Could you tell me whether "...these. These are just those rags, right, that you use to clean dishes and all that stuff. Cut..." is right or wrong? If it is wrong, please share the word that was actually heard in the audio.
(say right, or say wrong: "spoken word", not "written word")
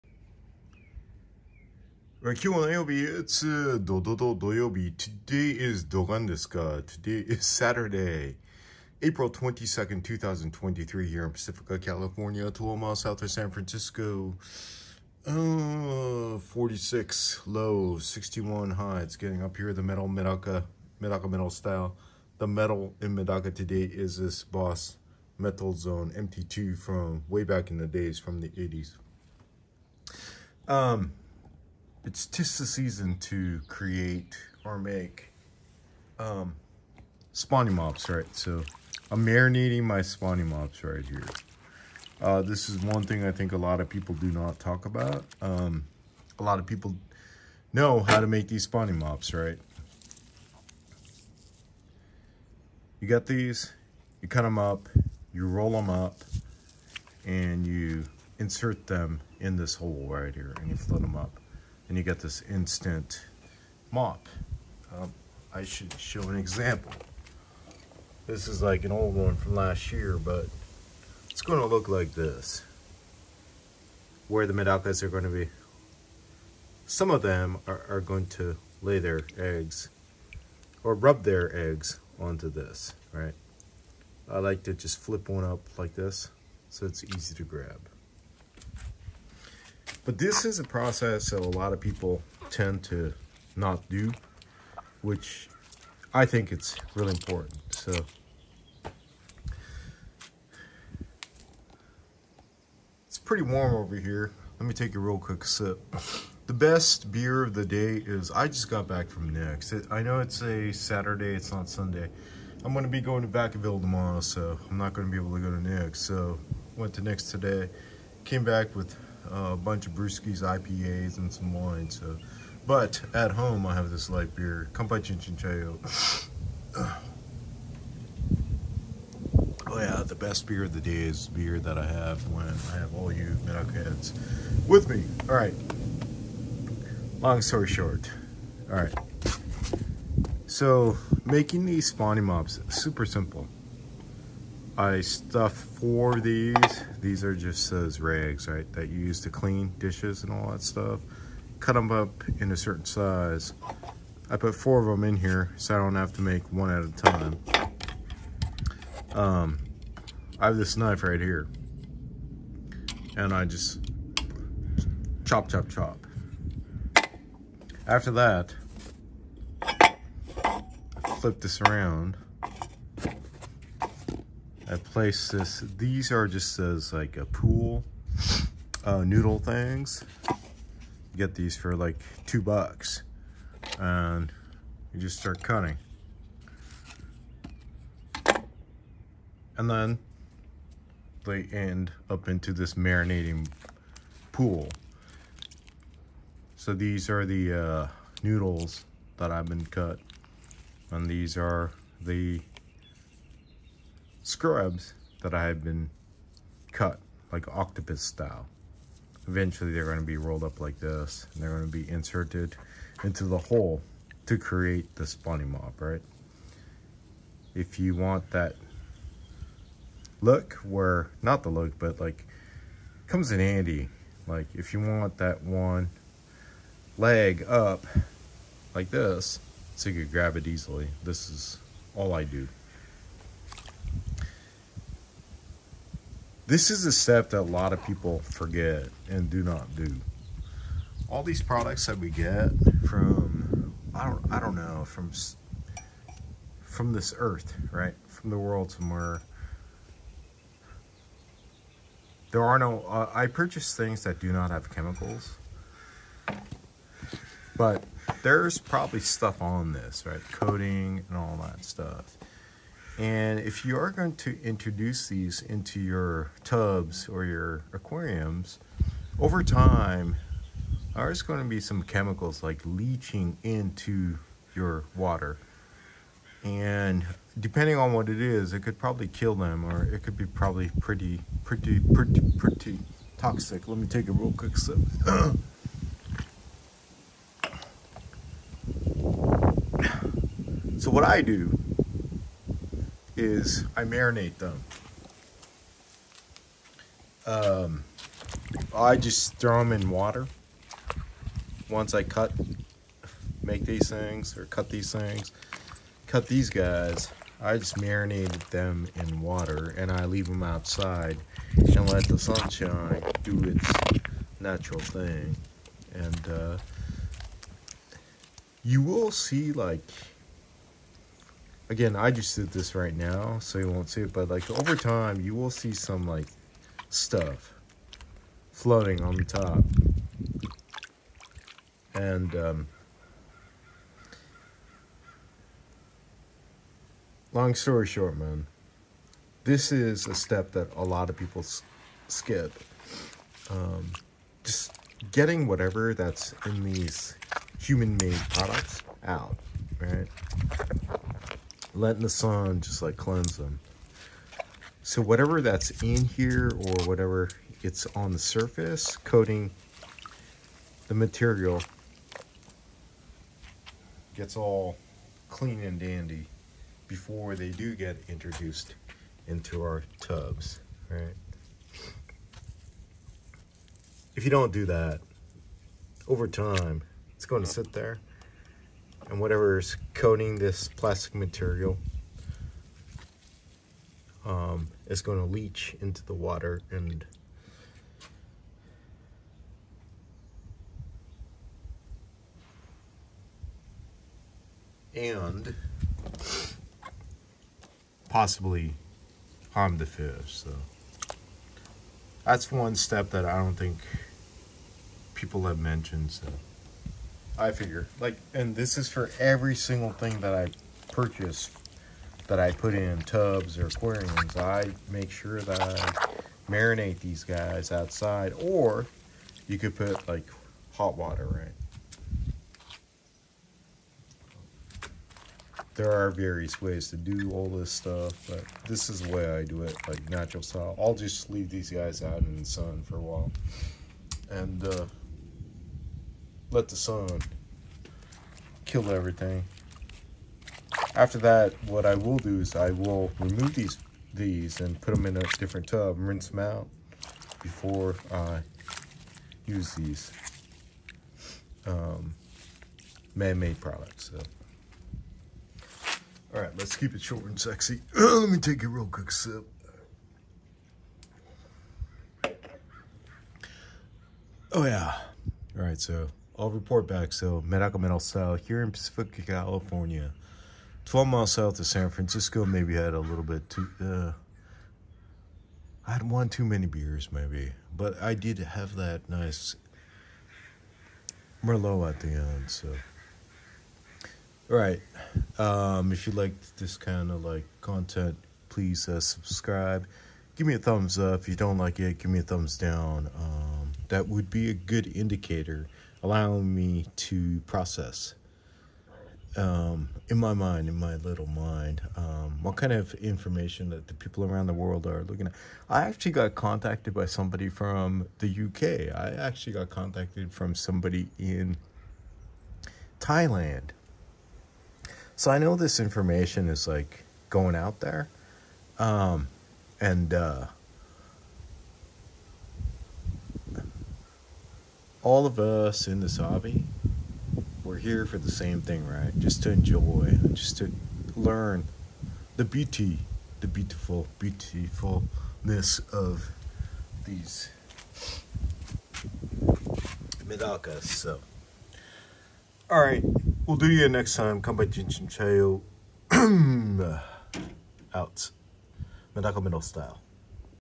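right.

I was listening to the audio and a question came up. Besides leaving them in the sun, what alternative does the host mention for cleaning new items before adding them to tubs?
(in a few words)
Hot water.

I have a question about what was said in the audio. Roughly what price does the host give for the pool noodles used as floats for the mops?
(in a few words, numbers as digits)
2 dollars.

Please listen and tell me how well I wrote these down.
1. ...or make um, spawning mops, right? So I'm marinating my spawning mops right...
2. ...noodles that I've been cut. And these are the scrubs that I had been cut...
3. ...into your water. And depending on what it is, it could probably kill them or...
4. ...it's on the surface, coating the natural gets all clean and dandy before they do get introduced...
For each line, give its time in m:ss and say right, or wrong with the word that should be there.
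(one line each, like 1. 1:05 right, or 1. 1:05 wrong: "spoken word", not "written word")
1. 0:34 right
2. 3:18 right
3. 4:33 right
4. 5:57 wrong: "material", not "natural".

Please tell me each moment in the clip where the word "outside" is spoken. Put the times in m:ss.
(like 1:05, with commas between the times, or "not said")
5:10, 6:57.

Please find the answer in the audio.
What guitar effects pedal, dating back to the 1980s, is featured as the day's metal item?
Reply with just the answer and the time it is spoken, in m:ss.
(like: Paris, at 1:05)
Boss Metal Zone MT2, at 0:24.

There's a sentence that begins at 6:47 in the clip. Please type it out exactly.
Like, and this is for every single thing that I purchase that I put in tubs or aquariums.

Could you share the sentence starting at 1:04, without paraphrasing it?
Um, I should show an example.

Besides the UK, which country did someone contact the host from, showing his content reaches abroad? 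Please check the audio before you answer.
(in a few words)
Thailand.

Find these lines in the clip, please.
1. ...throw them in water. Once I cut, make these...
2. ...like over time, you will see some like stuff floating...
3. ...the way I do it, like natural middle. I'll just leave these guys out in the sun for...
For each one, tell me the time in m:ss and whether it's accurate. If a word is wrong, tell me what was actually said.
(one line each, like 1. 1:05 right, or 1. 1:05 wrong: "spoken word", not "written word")
1. 4:59 right
2. 5:24 right
3. 7:09 wrong: "style", not "middle".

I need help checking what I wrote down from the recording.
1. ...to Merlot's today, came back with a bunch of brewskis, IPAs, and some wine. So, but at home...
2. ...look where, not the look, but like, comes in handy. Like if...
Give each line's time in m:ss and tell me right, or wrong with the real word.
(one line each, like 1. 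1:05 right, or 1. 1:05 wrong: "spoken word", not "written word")
1. 1:56 wrong: "Nick", not "Merlot"
2. 3:40 right.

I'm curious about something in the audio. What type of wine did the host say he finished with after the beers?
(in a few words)
Merlot.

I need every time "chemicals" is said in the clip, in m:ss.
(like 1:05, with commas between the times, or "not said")
4:14, 4:31.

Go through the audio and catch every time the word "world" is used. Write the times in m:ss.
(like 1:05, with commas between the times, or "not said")
4:08, 8:24.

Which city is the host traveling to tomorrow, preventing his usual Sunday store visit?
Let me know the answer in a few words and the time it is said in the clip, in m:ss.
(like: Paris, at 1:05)
Vacaville, at 1:53.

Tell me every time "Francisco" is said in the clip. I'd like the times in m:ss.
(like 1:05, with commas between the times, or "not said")
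0:13, 7:51.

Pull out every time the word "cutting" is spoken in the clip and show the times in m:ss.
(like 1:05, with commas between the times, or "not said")
3:05.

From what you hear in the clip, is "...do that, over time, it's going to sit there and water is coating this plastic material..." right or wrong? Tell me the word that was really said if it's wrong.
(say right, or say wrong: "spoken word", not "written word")
wrong: "whatever", not "water".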